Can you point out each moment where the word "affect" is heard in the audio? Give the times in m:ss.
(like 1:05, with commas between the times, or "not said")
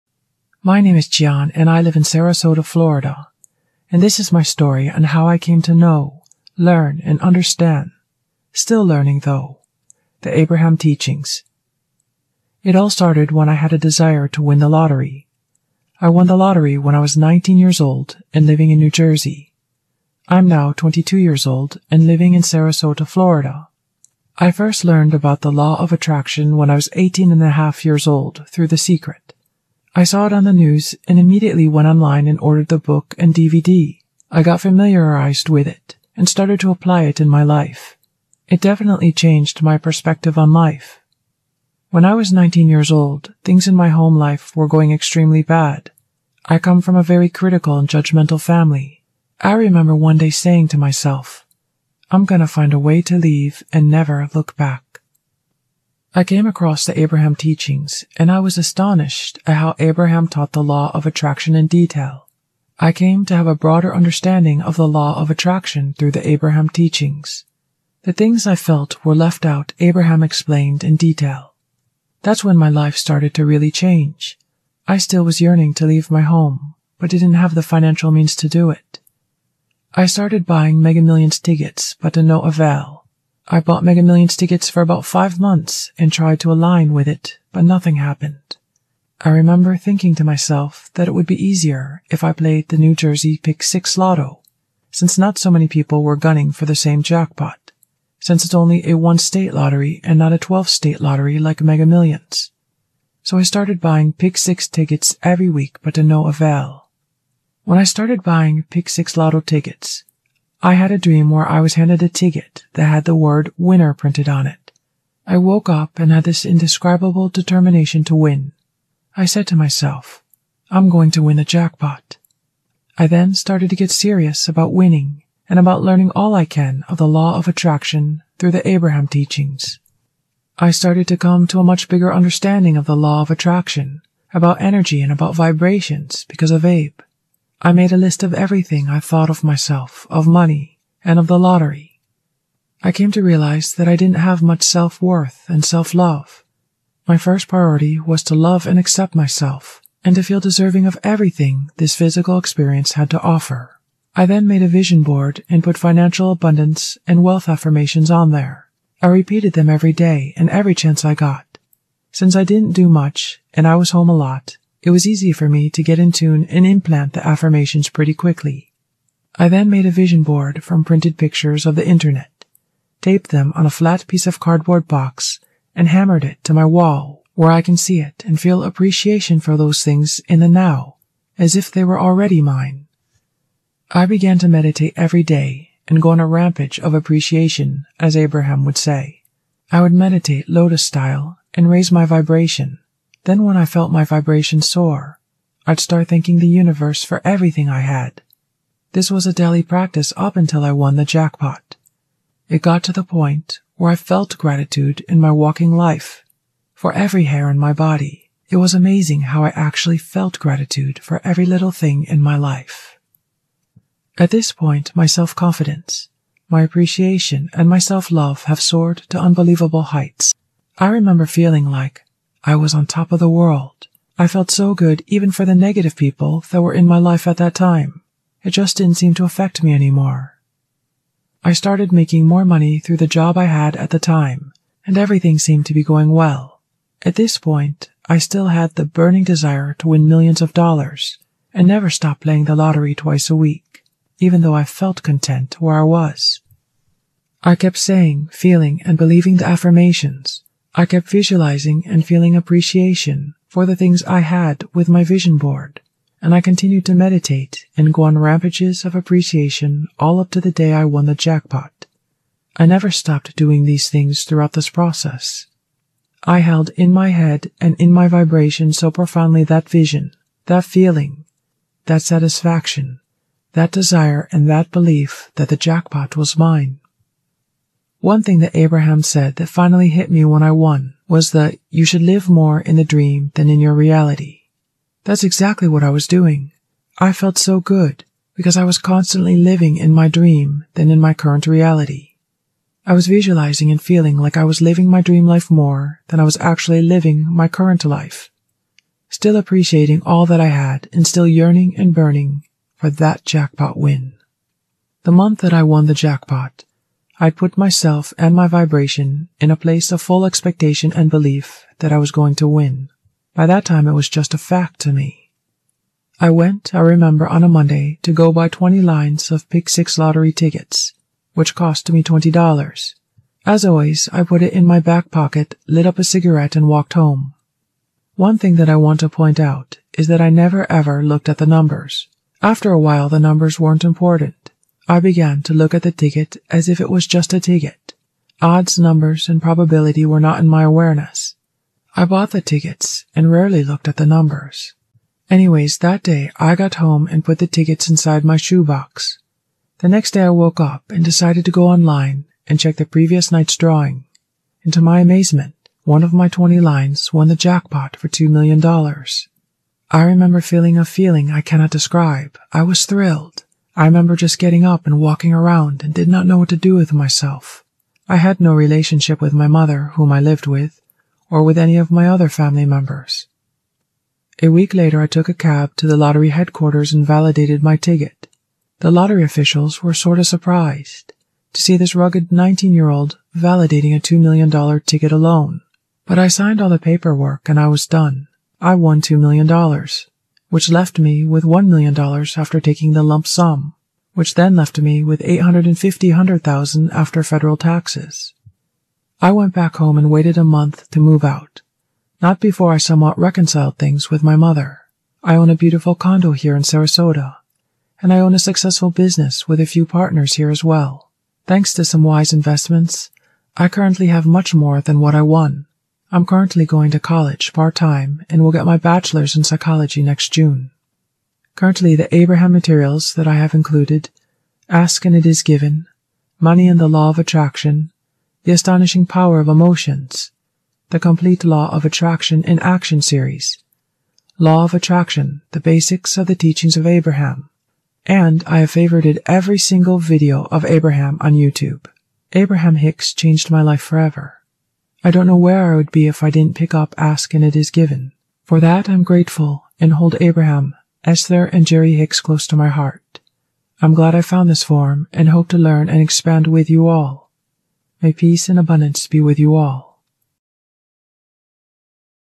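3:49.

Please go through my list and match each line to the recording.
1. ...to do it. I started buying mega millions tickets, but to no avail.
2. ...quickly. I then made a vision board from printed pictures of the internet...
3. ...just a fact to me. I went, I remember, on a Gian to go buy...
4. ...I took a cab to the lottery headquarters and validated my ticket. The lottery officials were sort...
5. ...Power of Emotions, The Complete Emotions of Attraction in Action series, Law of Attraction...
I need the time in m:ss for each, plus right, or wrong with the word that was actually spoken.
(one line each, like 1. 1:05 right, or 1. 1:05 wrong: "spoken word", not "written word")
1. 1:18 right
2. 2:48 right
3. 5:14 wrong: "Monday", not "Gian"
4. 6:15 right
5. 7:09 wrong: "Law", not "Emotions".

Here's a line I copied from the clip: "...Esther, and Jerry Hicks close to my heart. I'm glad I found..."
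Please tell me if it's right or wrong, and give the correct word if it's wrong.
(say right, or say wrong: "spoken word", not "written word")
right.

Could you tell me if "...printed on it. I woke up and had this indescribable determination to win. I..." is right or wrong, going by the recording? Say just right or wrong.
right.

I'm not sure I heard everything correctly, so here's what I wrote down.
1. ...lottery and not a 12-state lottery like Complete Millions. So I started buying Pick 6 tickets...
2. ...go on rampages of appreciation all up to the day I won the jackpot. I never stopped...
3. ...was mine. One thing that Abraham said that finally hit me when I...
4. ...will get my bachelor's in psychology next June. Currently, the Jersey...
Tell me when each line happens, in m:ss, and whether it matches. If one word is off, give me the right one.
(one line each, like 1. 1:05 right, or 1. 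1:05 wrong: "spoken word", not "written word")
1. 1:39 wrong: "Mega", not "Complete"
2. 4:17 right
3. 4:36 right
4. 6:58 wrong: "Abraham", not "Jersey".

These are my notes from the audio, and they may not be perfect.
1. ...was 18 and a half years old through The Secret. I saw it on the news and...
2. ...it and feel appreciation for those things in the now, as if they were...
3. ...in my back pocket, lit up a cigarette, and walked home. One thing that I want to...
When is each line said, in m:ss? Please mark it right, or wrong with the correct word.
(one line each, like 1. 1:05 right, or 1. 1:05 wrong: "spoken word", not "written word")
1. 0:26 right
2. 2:58 right
3. 5:24 right.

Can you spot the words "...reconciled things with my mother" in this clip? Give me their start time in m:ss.
6:43.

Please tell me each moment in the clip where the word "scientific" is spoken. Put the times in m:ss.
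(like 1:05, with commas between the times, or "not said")
not said.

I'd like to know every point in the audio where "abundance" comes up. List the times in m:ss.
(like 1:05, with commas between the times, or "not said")
2:36, 7:38.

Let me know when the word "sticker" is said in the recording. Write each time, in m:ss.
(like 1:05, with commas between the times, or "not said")
not said.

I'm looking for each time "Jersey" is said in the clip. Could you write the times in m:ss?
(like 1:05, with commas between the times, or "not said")
0:18, 1:32.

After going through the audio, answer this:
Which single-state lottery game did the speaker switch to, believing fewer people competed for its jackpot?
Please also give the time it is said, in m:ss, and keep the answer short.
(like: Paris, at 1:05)
Pick 6 Lotto, at 1:32.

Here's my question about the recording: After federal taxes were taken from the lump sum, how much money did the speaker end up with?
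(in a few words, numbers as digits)
$850,000.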